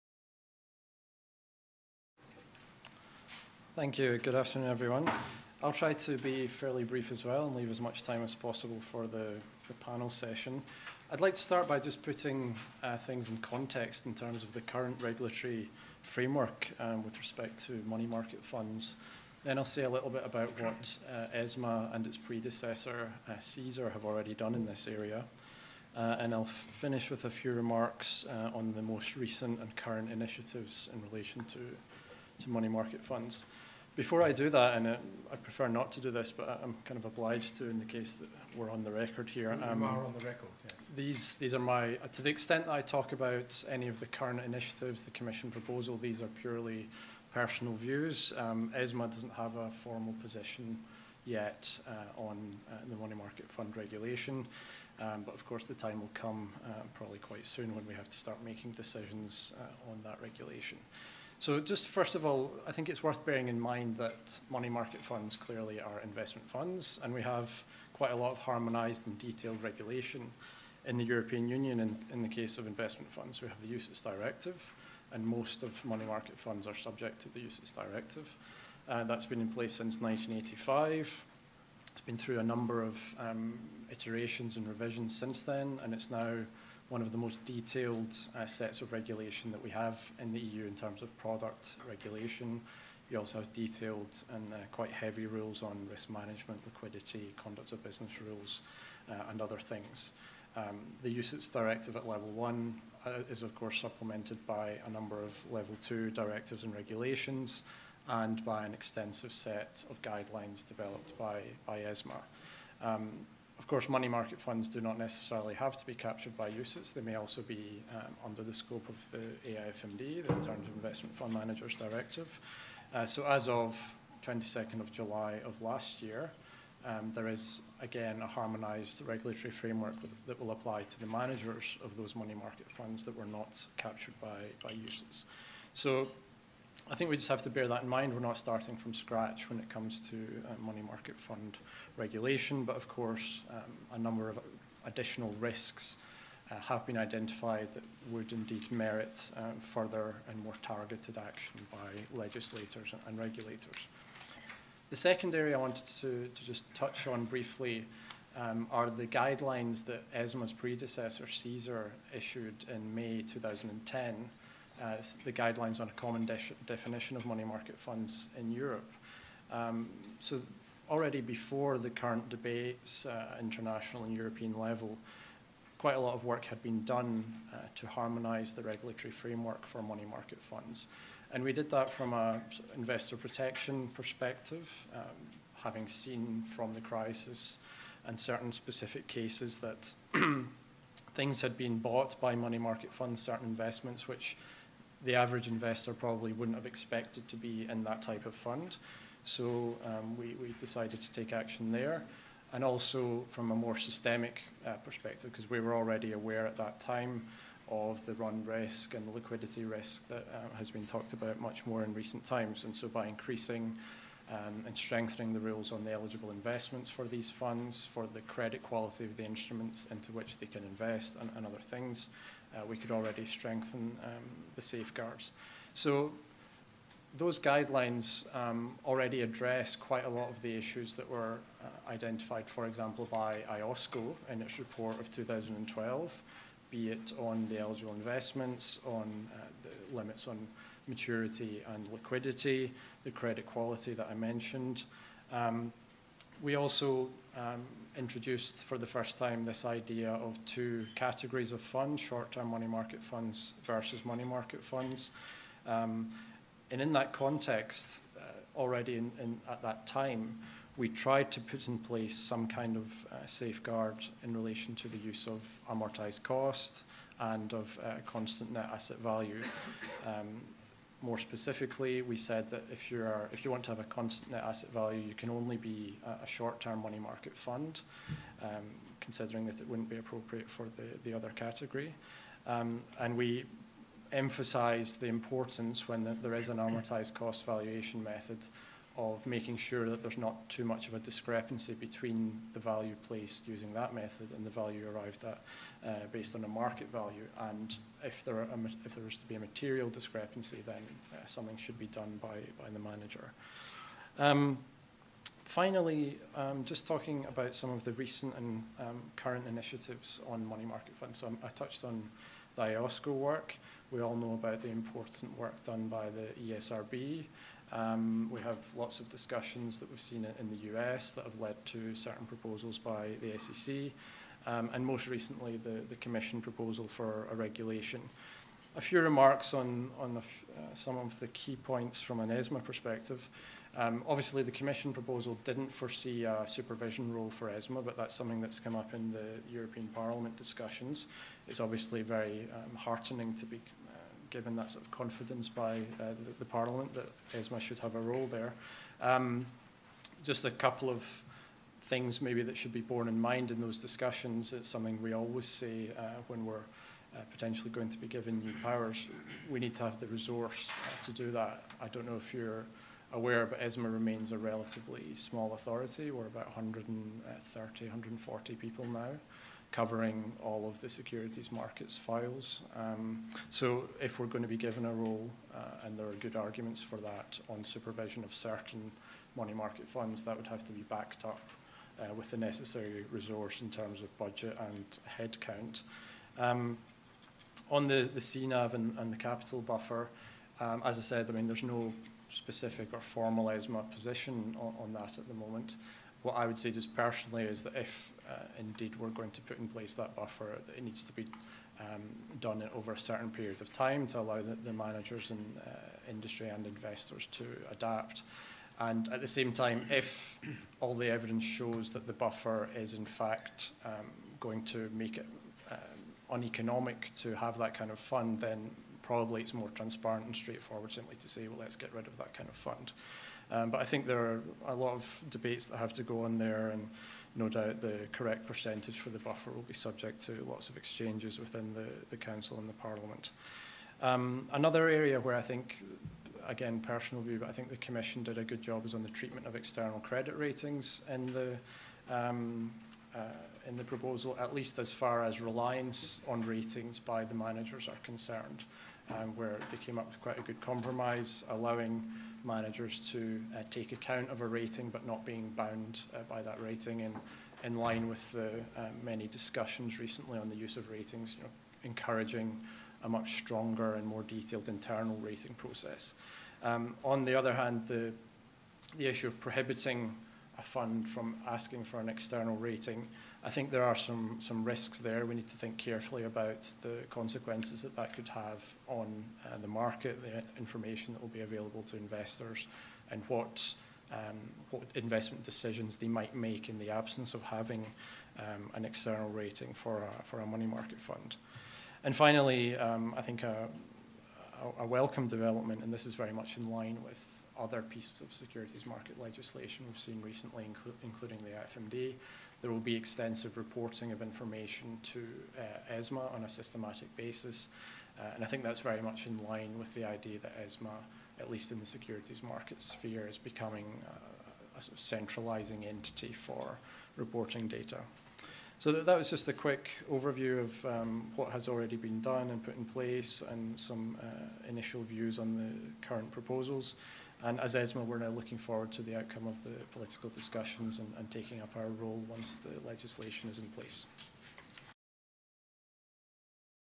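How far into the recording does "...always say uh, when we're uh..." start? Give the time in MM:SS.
05:55.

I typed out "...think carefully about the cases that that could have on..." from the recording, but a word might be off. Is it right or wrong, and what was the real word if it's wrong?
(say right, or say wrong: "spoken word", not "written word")
wrong: "consequences", not "cases".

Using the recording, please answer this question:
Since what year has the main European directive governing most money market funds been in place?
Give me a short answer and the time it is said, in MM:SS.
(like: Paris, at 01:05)
1985, at 01:19.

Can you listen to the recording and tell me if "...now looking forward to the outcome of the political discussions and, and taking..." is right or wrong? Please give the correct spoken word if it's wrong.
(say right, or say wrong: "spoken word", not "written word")
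right.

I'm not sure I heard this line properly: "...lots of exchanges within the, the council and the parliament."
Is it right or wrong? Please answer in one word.
right.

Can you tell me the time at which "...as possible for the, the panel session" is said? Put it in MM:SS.
00:08.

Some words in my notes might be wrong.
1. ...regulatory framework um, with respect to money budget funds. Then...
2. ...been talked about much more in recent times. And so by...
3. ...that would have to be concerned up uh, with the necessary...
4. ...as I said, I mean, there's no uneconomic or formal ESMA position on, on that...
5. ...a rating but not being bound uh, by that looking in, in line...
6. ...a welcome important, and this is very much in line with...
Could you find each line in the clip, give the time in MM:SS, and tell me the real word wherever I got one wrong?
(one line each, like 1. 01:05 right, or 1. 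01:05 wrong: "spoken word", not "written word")
1. 00:15 wrong: "market", not "budget"
2. 03:30 right
3. 06:20 wrong: "backed", not "concerned"
4. 06:30 wrong: "specific", not "uneconomic"
5. 07:34 wrong: "rating", not "looking"
6. 08:14 wrong: "development", not "important".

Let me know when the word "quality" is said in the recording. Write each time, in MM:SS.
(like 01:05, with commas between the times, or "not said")
03:38, 04:03.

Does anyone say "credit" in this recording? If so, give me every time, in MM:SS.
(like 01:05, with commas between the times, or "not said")
03:38, 04:03, 07:19.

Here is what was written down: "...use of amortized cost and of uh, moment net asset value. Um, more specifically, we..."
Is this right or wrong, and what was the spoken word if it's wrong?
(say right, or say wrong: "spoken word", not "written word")
wrong: "constant", not "moment".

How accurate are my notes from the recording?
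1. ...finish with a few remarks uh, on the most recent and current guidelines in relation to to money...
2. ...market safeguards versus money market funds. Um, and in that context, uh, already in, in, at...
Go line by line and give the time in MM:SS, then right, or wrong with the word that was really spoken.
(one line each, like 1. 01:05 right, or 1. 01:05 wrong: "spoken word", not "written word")
1. 00:26 wrong: "initiatives", not "guidelines"
2. 04:12 wrong: "funds", not "safeguards".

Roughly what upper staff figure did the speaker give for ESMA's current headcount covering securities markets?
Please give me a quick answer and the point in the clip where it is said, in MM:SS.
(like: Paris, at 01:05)
140, at 06:07.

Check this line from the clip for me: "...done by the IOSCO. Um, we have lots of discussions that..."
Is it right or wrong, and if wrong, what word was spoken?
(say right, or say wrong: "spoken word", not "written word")
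wrong: "ESRB", not "IOSCO".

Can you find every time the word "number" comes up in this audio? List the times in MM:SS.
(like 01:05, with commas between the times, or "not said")
01:22, 01:44, 02:23.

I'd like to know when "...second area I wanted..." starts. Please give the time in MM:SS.
02:34.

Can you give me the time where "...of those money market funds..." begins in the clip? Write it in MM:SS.
02:11.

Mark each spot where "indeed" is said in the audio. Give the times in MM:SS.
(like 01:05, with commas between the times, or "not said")
02:28, 06:38.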